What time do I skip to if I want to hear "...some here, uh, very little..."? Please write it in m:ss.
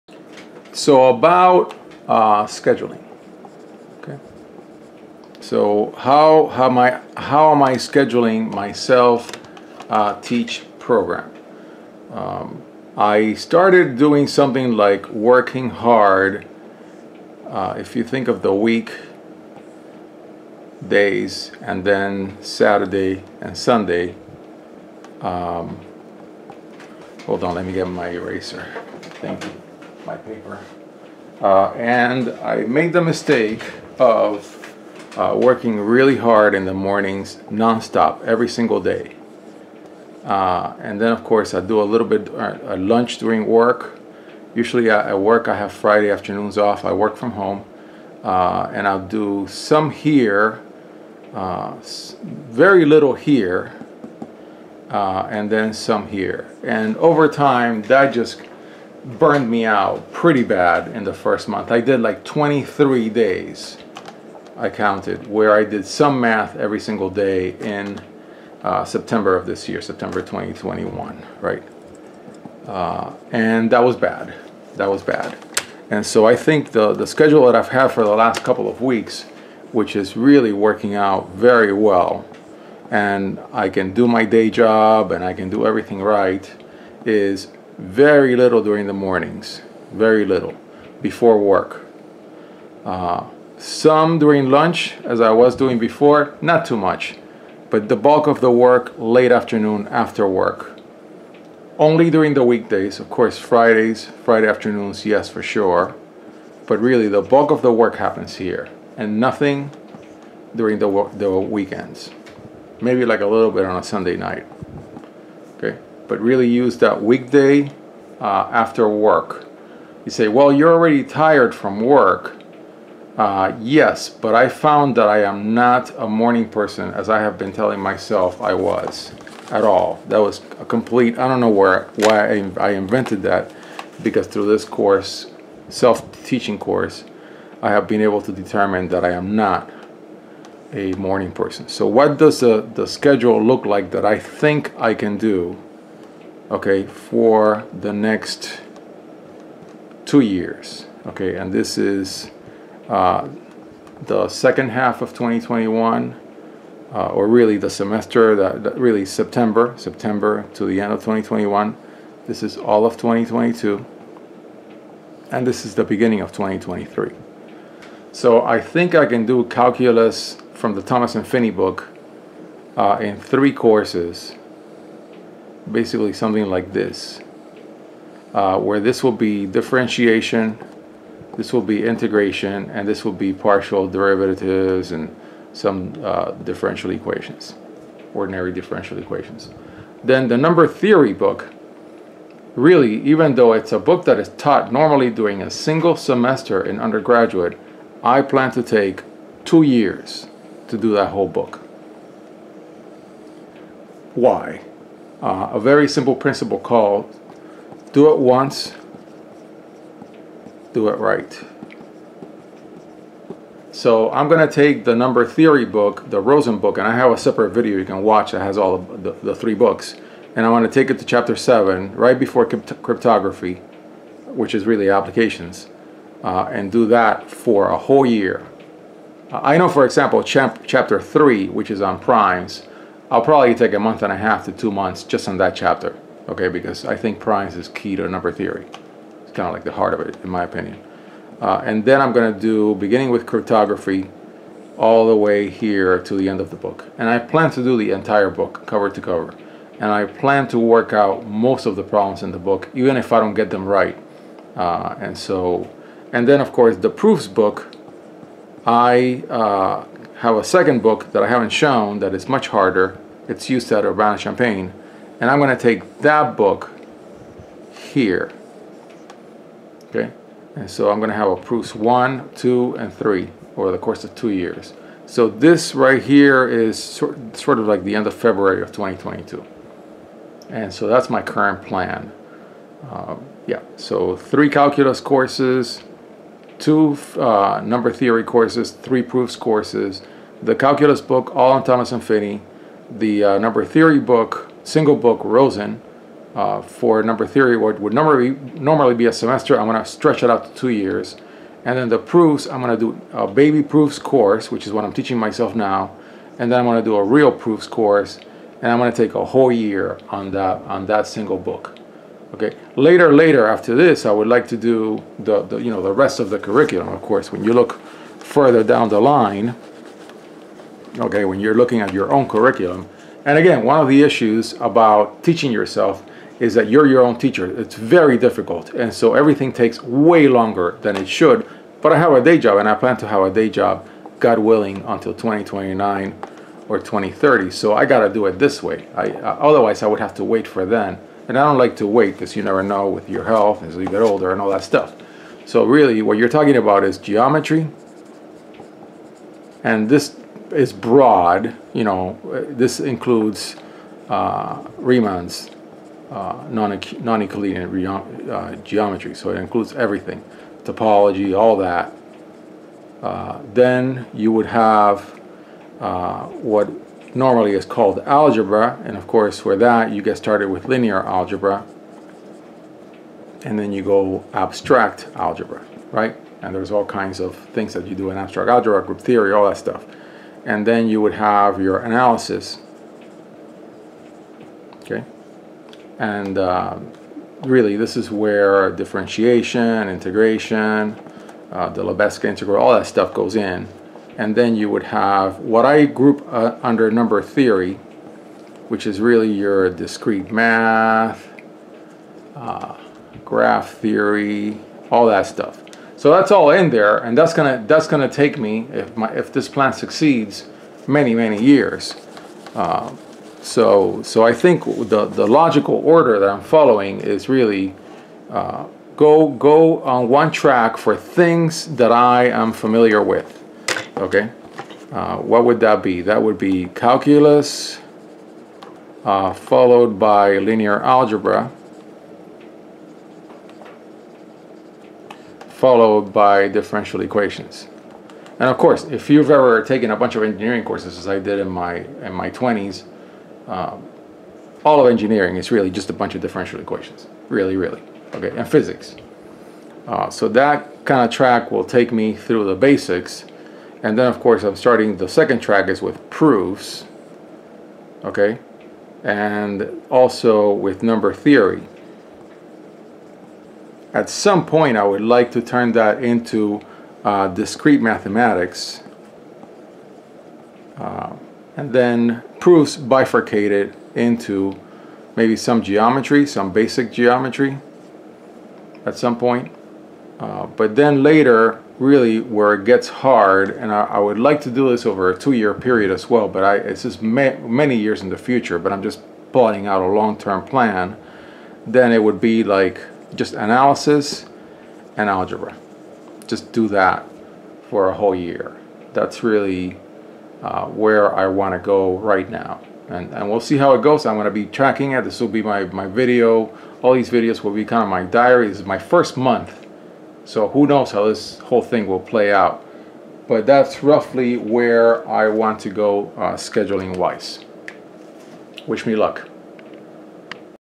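0:49.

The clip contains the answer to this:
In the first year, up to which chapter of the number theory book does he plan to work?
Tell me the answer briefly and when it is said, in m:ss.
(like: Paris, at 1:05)
chapter 7, at 3:41.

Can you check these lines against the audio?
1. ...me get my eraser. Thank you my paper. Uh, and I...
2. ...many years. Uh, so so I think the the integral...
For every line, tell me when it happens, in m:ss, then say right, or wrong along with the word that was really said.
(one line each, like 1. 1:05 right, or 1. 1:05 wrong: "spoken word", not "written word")
1. 0:27 right
2. 6:51 wrong: "logical", not "integral".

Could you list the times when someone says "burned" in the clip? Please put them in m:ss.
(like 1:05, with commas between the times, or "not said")
0:59.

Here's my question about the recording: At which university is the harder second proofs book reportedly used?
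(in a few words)
Urbana-Champaign.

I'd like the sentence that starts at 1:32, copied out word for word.
Uh, some during lunch, as I was doing before, not too much, but the bulk of the work late afternoon after work.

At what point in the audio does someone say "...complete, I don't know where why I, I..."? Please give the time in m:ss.
2:10.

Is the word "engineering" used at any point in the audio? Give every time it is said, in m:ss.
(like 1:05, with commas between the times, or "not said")
7:20, 7:24.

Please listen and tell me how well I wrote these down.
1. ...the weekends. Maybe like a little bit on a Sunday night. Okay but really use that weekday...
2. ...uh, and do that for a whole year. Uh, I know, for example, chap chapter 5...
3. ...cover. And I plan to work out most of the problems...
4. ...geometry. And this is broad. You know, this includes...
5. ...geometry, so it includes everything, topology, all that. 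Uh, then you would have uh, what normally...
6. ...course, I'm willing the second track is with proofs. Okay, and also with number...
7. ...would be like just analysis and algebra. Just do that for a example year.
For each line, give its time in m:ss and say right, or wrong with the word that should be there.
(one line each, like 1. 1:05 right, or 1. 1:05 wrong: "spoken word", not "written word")
1. 1:51 right
2. 3:46 wrong: "3", not "5"
3. 4:09 right
4. 5:46 right
5. 5:58 right
6. 7:34 wrong: "starting", not "willing"
7. 8:12 wrong: "whole", not "example".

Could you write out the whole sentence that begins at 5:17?
When you look further down the line, okay, when you're looking at your own curriculum.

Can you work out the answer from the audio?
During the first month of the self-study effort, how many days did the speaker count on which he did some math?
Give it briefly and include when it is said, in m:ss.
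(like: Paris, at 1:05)
23, at 1:02.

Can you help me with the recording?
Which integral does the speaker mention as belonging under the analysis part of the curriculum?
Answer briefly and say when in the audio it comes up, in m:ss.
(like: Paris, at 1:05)
Lebesgue integral, at 6:31.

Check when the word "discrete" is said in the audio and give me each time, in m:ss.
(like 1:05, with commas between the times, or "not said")
6:39, 7:47.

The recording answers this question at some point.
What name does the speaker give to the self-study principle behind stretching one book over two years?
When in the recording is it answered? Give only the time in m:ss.
3:27.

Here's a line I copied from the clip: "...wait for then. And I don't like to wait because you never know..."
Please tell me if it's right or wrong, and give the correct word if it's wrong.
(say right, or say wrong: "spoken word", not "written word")
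right.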